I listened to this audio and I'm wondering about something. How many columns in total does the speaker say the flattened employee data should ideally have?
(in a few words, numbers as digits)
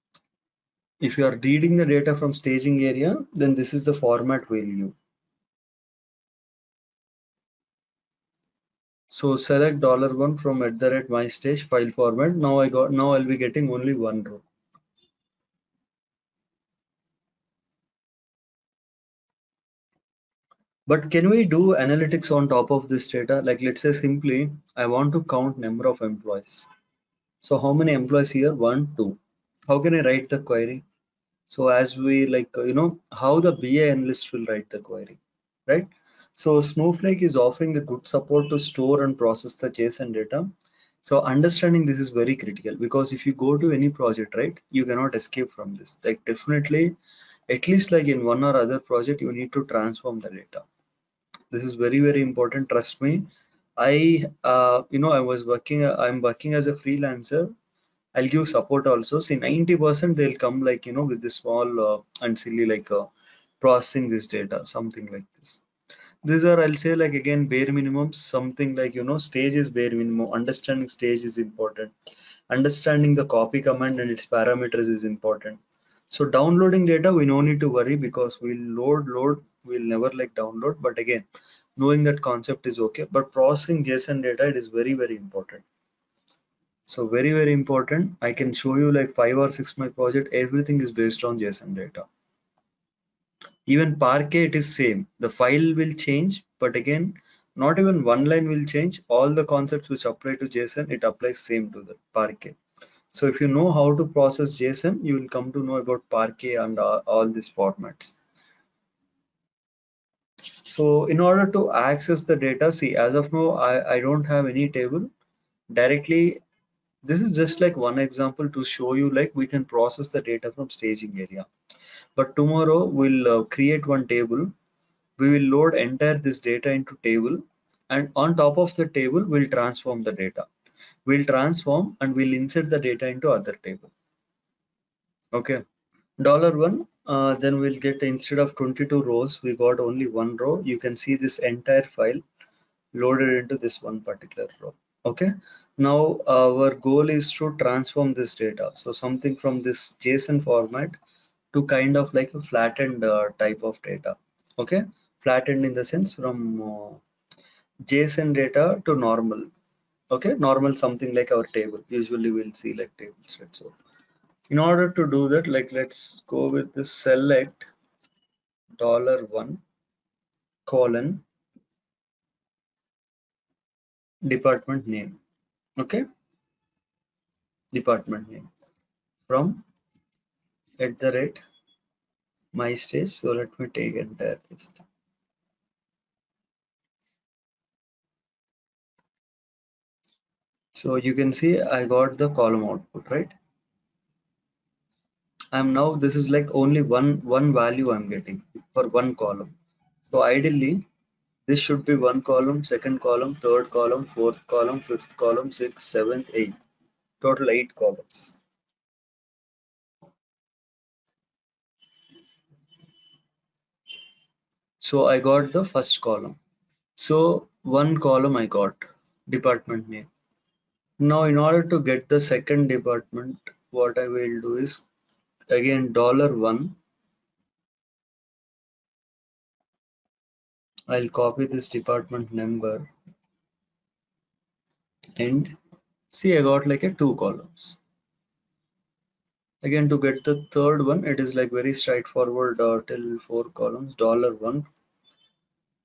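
8.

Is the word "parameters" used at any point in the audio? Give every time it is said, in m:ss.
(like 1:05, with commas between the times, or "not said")
1:14.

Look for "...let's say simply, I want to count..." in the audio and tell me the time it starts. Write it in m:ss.
0:23.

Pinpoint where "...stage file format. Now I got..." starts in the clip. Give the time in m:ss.
0:11.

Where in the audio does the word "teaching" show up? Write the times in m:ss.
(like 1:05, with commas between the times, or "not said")
not said.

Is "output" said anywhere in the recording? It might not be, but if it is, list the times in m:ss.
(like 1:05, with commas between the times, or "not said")
3:12.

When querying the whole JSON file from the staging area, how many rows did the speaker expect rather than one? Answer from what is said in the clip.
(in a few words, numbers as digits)
22.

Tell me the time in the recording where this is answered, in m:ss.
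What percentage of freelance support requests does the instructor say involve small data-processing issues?
0:59.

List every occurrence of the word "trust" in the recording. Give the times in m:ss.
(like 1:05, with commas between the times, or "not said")
0:52.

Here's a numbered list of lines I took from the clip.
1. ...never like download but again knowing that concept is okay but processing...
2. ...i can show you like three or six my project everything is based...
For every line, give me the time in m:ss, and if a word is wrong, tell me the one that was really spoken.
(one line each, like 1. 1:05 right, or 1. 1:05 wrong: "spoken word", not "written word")
1. 1:19 right
2. 1:28 wrong: "five", not "three".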